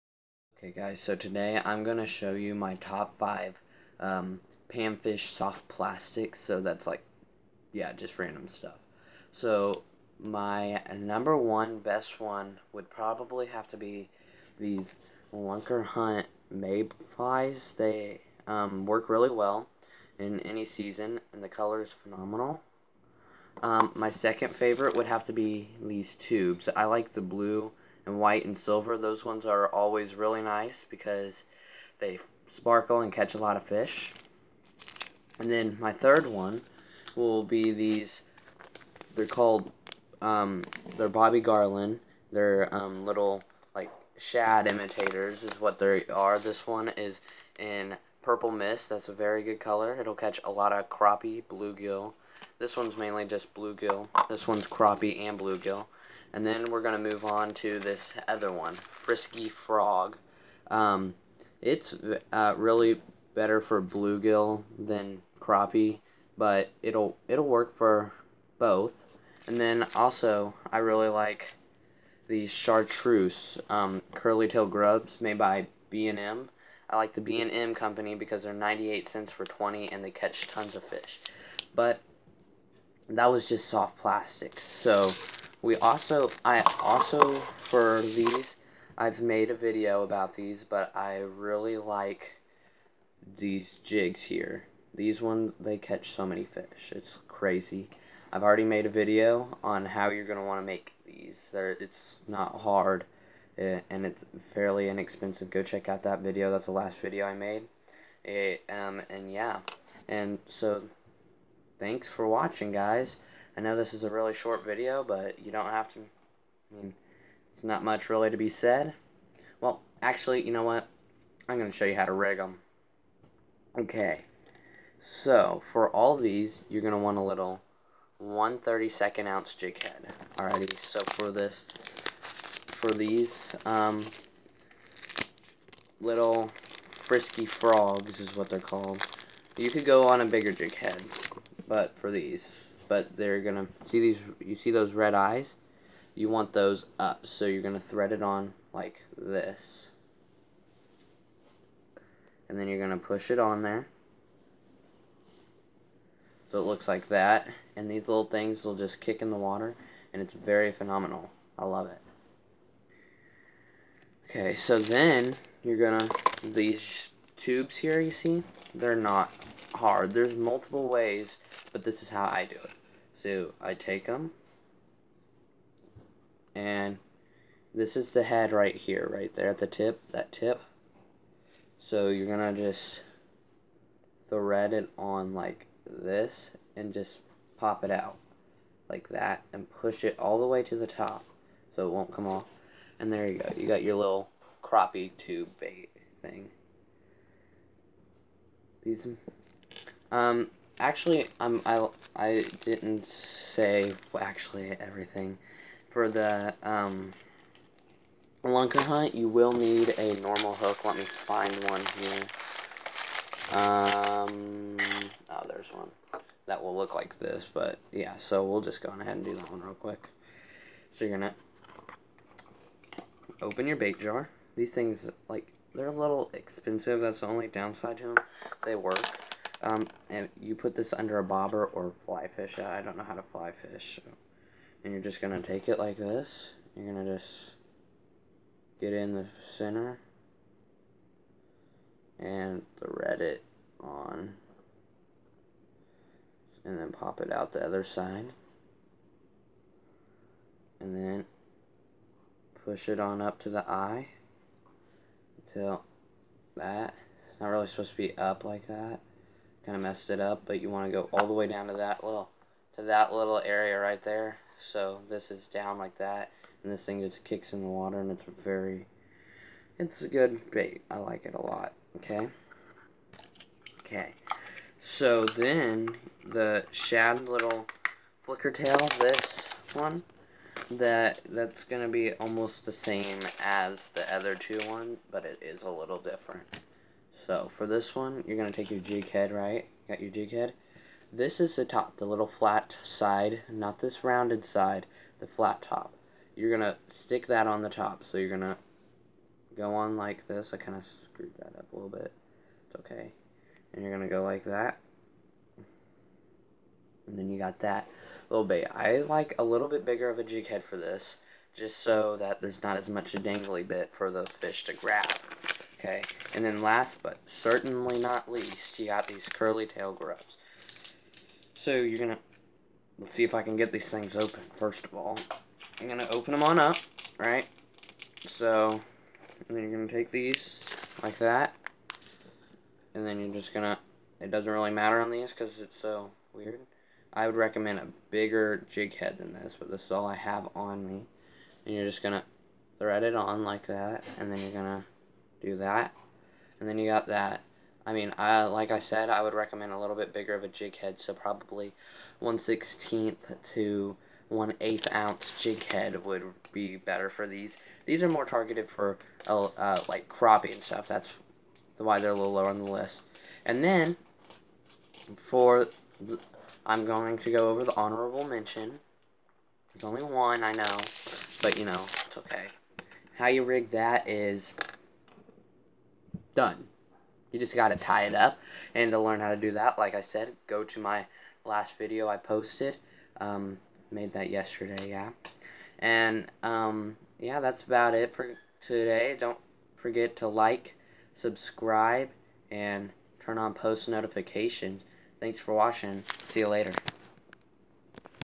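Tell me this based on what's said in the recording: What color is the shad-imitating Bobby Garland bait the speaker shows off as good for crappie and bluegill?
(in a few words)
Purple mist.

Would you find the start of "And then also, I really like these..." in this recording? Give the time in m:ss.
1:09.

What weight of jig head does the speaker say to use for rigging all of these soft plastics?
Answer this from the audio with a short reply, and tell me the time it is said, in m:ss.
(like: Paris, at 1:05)
1/32 ounce, at 2:08.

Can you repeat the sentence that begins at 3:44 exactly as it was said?
These things, like, they're a little expensive.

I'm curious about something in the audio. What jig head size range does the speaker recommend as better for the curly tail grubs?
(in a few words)
1/16 to 1/8 ounce.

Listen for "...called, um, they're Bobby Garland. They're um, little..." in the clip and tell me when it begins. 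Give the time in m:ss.
0:39.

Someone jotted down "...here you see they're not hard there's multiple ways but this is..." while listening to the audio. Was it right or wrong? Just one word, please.
right.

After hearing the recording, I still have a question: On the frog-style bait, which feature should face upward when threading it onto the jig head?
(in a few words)
Red eyes.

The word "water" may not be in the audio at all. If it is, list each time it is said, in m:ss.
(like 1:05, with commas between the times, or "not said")
2:39, 4:27.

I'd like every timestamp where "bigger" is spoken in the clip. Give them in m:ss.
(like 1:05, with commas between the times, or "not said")
2:20, 5:09, 5:38, 5:50.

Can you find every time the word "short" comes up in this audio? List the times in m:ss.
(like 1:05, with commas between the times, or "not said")
1:54.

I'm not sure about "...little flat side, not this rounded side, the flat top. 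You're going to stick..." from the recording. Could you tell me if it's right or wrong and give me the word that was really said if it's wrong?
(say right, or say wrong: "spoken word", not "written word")
right.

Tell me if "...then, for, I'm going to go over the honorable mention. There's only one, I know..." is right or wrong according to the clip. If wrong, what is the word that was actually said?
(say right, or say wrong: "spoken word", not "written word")
right.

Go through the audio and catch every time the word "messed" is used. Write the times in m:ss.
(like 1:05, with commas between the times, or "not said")
4:19.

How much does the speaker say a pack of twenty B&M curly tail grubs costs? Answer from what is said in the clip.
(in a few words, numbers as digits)
98 cents.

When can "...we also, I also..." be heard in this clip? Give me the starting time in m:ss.
1:25.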